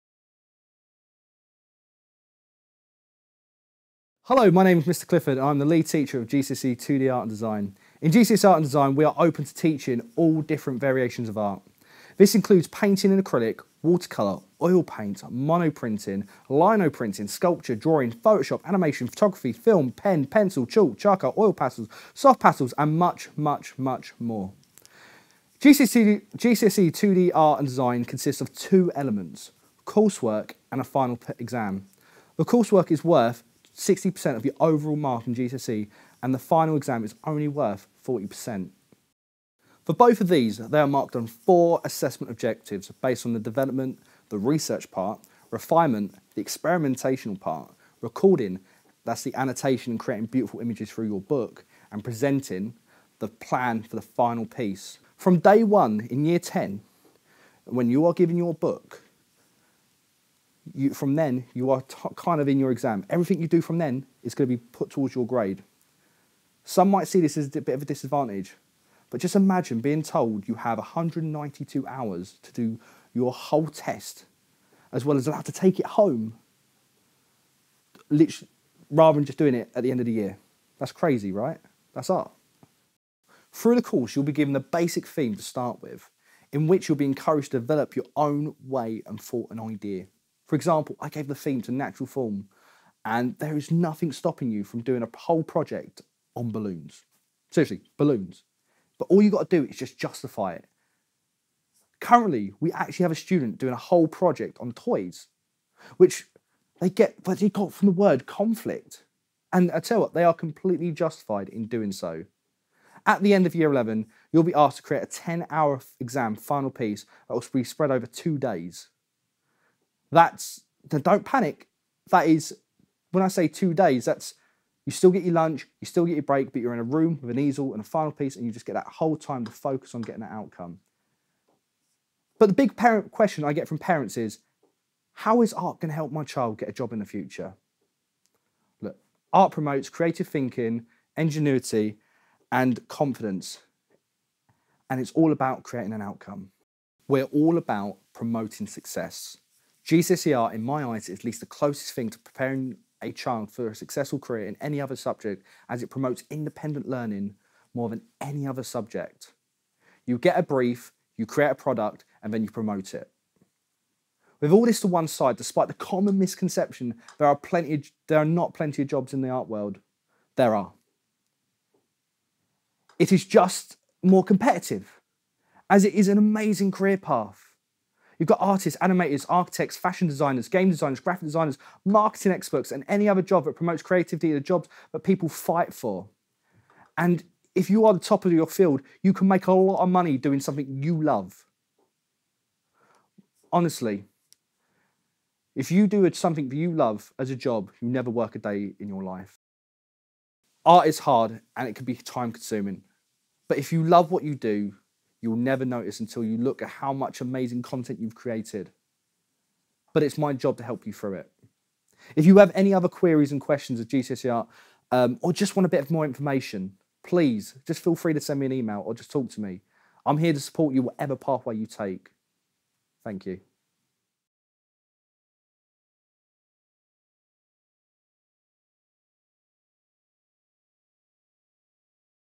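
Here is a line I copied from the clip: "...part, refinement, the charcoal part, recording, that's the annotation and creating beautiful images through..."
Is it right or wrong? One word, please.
wrong.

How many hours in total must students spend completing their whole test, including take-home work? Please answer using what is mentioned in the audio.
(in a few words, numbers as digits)
192.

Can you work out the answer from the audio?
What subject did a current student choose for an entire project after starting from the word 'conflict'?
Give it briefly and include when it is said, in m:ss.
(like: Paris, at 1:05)
Toys, at 1:44.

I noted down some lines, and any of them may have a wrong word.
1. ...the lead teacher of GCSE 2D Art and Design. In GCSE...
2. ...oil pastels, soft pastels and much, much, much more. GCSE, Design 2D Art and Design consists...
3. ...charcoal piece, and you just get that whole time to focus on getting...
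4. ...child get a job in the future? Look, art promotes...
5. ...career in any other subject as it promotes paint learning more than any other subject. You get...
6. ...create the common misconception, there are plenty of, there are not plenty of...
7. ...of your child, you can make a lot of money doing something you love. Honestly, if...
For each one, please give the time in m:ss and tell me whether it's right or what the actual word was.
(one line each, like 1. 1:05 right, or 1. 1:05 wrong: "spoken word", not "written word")
1. 0:05 right
2. 0:21 wrong: "GCSE", not "Design"
3. 2:07 wrong: "final", not "charcoal"
4. 2:16 right
5. 2:34 wrong: "independent", not "paint"
6. 2:45 wrong: "despite", not "create"
7. 3:08 wrong: "field", not "child".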